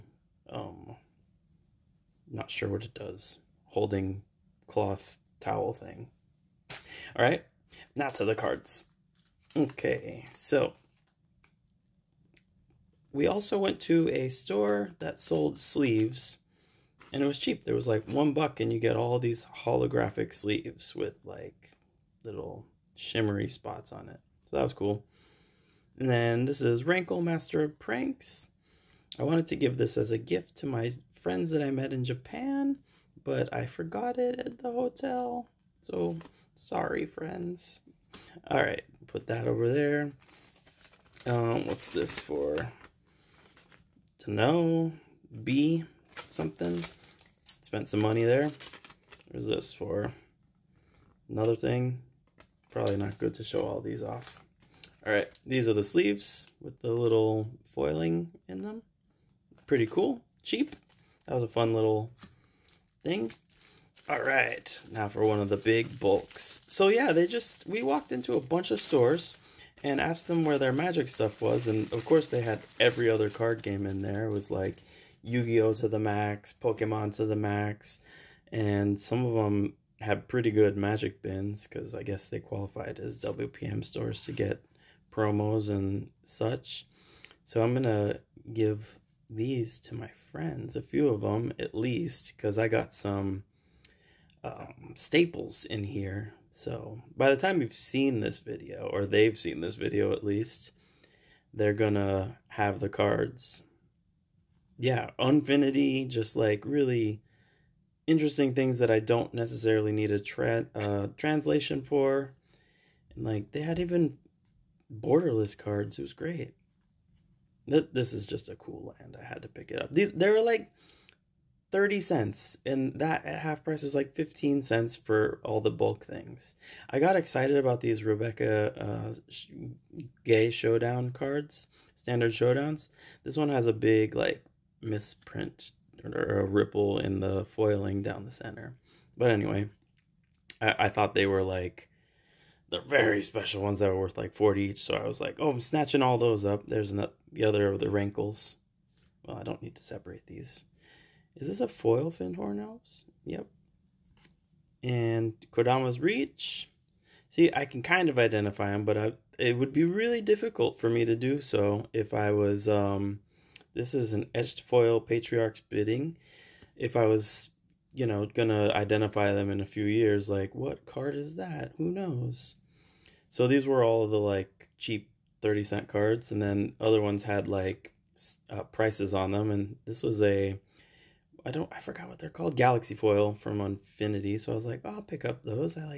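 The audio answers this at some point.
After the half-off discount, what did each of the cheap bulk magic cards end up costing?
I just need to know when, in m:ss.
2:04.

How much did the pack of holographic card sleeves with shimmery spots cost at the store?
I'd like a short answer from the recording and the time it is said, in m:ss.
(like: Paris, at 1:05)
1 dollar, at 0:18.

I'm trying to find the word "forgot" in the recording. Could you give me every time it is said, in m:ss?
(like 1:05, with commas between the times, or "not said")
0:33, 3:01.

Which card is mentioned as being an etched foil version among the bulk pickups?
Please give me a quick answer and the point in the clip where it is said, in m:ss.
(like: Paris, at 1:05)
Patriarch's Bidding, at 2:44.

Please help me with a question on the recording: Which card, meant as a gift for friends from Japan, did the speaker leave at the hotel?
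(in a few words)
Rankle, Master of Pranks.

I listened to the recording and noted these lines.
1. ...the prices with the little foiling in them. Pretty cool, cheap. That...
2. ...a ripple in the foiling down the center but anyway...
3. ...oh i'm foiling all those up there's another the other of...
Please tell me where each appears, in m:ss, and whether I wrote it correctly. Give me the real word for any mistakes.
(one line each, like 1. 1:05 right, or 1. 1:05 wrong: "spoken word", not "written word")
1. 0:55 wrong: "sleeves", not "prices"
2. 2:16 right
3. 2:25 wrong: "snatching", not "foiling".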